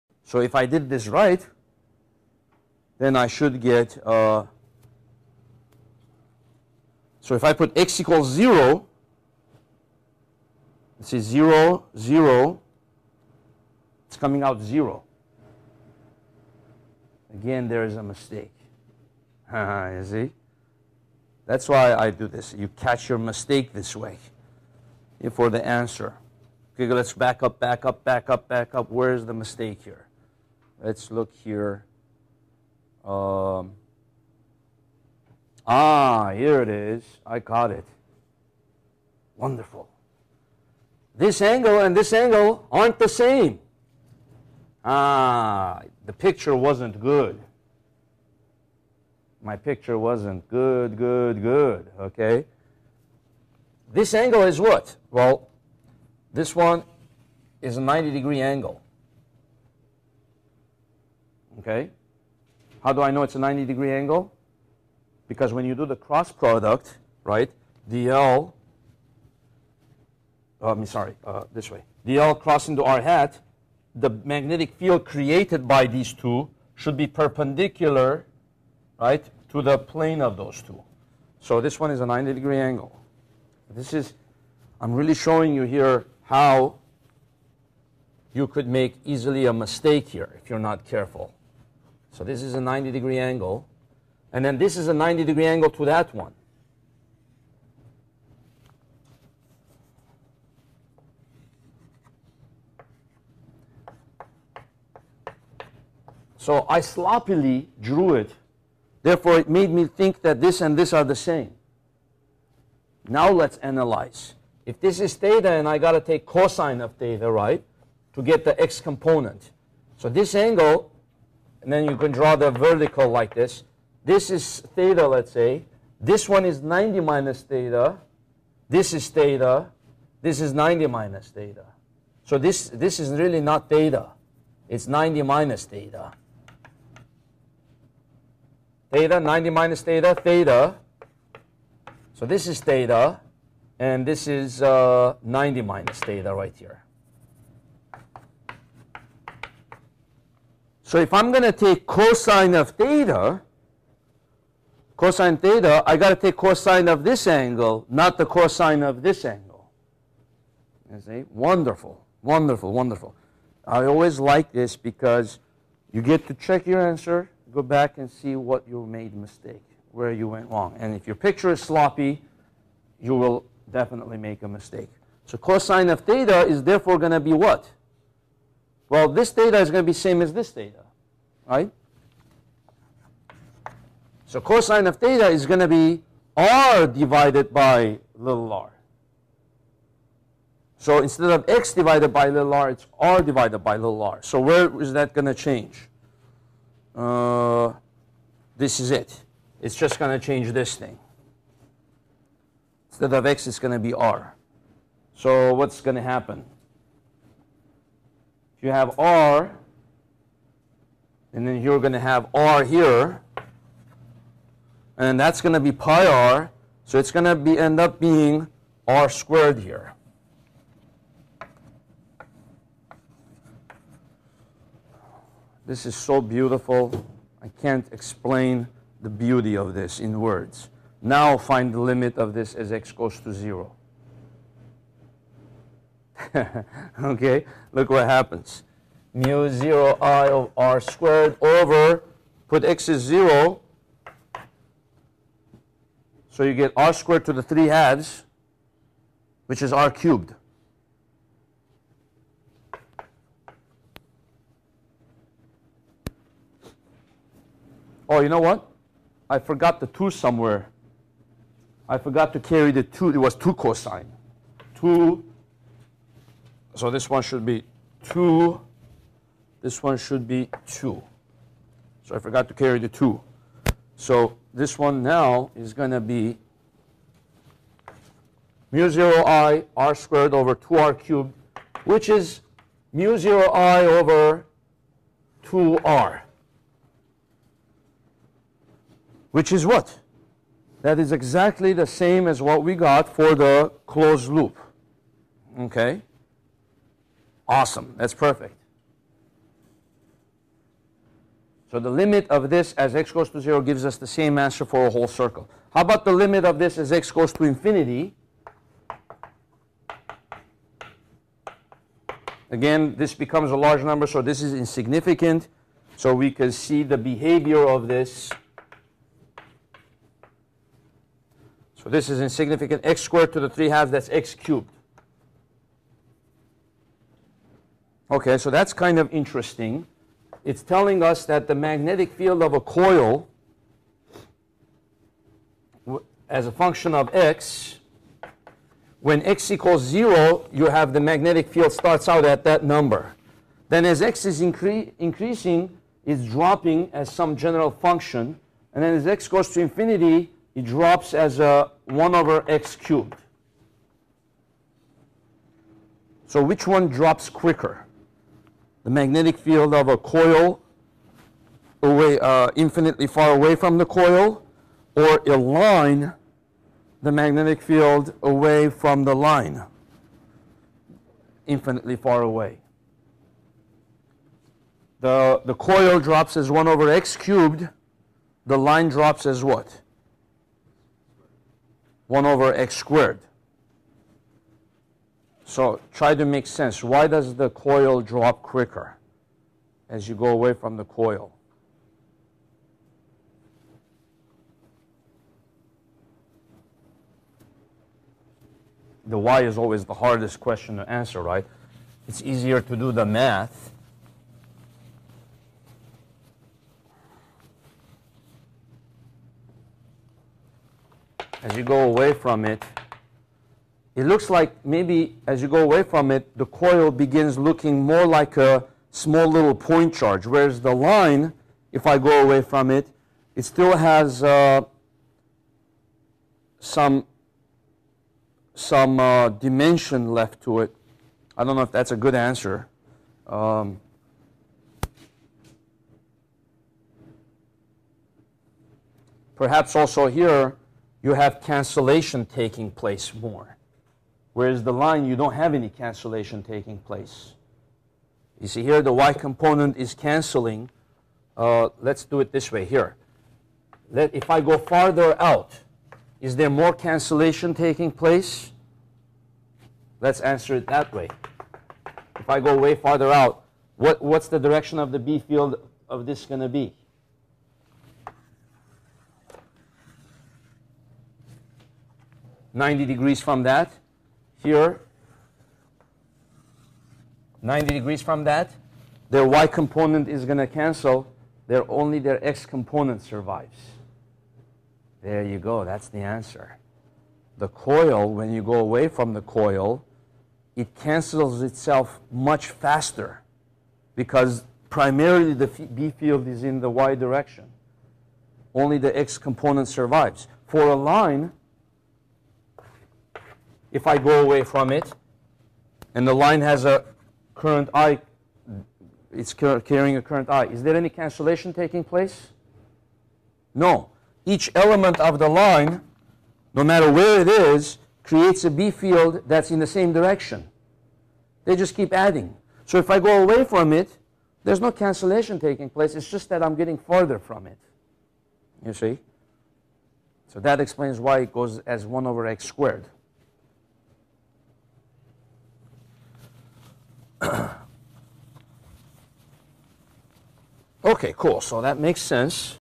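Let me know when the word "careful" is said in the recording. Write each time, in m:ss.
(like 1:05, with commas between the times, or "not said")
1:30.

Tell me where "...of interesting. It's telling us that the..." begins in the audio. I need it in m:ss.
5:28.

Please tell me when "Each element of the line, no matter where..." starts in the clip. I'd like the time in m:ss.
8:34.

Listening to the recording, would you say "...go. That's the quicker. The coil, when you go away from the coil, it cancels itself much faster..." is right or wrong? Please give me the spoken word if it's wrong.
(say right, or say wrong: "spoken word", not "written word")
wrong: "answer", not "quicker".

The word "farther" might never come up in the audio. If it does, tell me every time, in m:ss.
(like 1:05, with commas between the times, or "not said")
7:34, 7:42, 8:46.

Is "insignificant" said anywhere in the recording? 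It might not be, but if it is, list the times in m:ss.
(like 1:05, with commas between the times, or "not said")
5:14, 5:22.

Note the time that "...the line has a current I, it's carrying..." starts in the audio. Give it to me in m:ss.
8:26.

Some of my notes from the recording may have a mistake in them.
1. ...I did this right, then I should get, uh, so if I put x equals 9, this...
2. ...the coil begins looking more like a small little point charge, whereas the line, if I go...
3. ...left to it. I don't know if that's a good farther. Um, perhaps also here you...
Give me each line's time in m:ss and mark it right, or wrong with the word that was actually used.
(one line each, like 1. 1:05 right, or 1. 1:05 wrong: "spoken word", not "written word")
1. 0:00 wrong: "0", not "9"
2. 6:56 right
3. 7:10 wrong: "answer", not "farther".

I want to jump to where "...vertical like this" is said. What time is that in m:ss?
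2:02.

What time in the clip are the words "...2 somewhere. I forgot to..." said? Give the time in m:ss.
4:19.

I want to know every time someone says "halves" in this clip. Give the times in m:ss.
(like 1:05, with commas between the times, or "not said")
4:07, 5:23.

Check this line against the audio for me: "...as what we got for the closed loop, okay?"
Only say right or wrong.
right.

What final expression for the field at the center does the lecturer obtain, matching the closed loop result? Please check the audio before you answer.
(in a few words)
mu 0 i over 2r.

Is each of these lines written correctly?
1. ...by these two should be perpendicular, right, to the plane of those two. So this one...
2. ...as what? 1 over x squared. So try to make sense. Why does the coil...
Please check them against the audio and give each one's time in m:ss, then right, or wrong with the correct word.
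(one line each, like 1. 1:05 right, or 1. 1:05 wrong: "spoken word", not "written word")
1. 1:15 right
2. 6:19 right.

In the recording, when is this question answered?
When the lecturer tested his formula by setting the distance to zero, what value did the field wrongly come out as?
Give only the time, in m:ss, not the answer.
0:14.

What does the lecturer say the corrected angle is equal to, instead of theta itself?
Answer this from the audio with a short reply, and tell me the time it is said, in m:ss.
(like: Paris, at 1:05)
90 minus theta, at 2:14.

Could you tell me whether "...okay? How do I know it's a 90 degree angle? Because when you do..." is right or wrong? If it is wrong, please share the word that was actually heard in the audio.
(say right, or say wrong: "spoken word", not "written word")
right.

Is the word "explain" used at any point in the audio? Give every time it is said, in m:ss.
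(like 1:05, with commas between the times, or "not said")
3:47, 8:50.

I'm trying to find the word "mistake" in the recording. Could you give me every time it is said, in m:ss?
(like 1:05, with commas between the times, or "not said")
0:18, 0:23, 0:29, 1:29, 2:49, 2:54.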